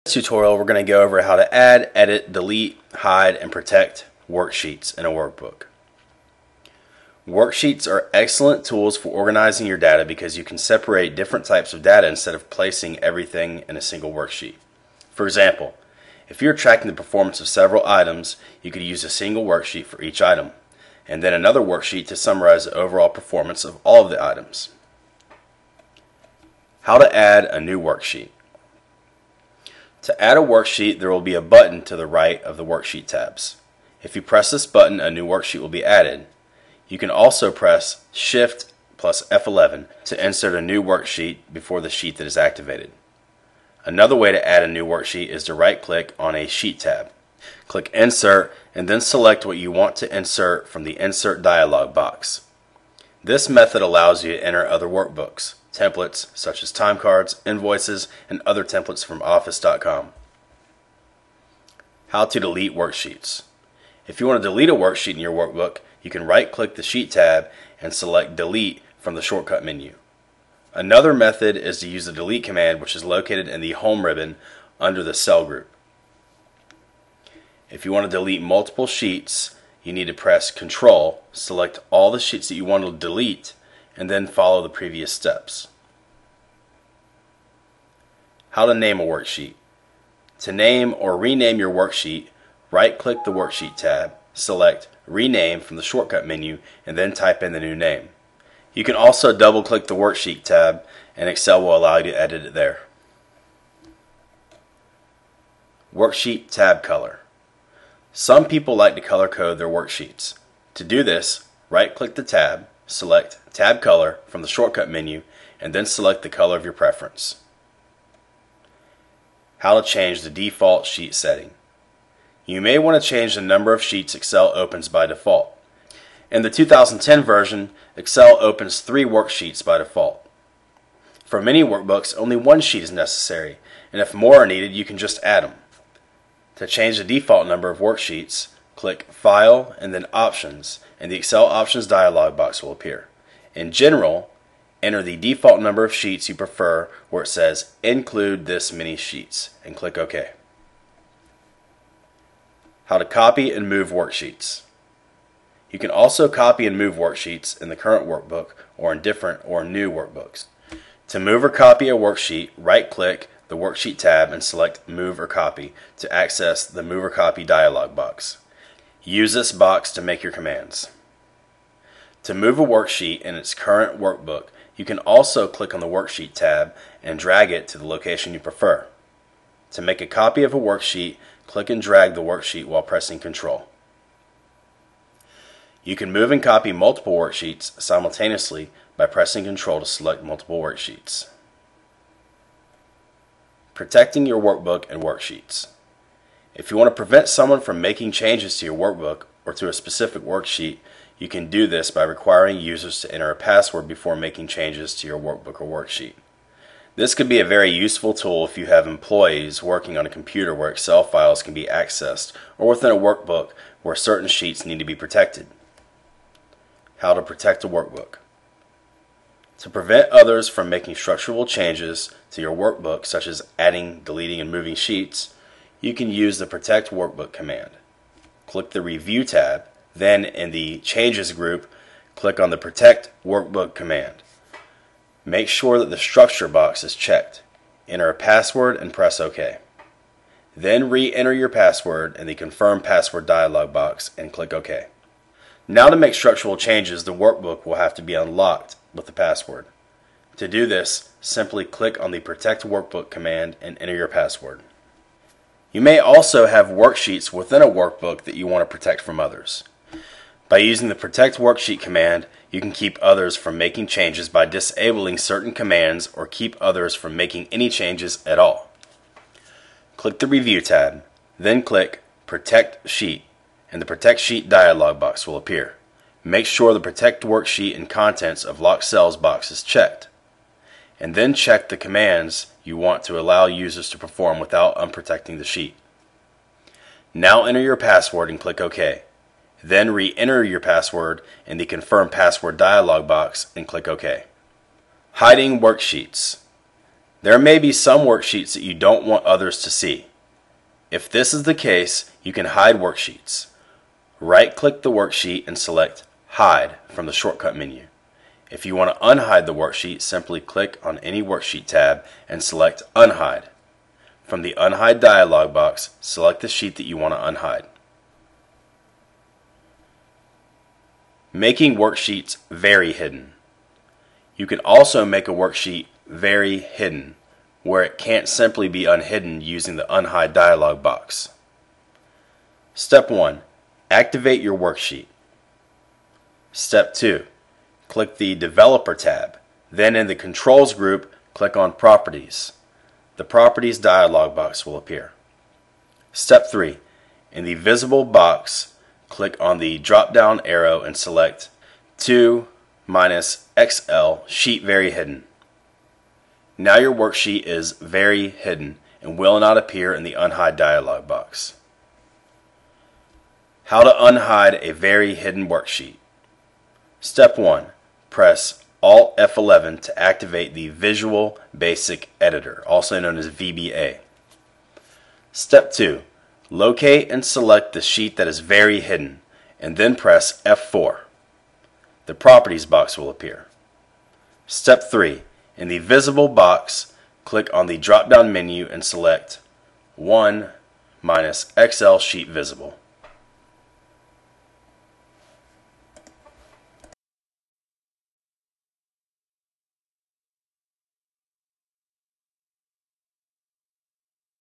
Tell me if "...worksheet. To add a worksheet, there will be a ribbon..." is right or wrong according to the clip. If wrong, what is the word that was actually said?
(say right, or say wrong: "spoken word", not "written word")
wrong: "button", not "ribbon".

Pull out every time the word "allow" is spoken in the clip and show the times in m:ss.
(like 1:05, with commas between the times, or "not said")
0:53, 1:41, 4:43.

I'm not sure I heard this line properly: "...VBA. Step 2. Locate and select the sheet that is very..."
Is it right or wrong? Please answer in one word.
right.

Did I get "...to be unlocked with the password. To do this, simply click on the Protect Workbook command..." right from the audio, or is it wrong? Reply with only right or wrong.
right.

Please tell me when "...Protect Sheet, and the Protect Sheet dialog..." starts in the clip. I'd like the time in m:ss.
4:32.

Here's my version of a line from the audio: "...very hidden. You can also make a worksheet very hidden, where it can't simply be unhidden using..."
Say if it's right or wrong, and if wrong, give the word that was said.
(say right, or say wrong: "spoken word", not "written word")
right.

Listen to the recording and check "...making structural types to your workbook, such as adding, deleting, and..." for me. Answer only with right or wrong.
wrong.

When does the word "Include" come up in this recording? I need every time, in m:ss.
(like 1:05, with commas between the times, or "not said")
2:27.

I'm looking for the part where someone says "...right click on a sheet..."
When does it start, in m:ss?
0:45.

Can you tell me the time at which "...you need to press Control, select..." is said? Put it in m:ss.
1:19.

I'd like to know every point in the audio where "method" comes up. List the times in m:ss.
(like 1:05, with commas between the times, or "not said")
0:53, 1:11.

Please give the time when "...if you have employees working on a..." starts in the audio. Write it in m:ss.
3:28.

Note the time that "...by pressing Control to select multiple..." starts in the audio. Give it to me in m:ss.
3:08.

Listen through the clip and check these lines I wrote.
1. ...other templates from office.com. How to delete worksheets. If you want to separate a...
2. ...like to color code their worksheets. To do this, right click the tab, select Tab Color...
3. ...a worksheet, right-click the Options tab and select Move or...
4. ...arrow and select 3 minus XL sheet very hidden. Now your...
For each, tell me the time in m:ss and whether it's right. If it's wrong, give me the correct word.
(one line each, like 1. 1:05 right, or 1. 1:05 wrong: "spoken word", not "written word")
1. 0:58 wrong: "delete", not "separate"
2. 1:48 right
3. 2:41 wrong: "Worksheet", not "Options"
4. 5:50 wrong: "2", not "3".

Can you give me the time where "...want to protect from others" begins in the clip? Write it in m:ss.
4:18.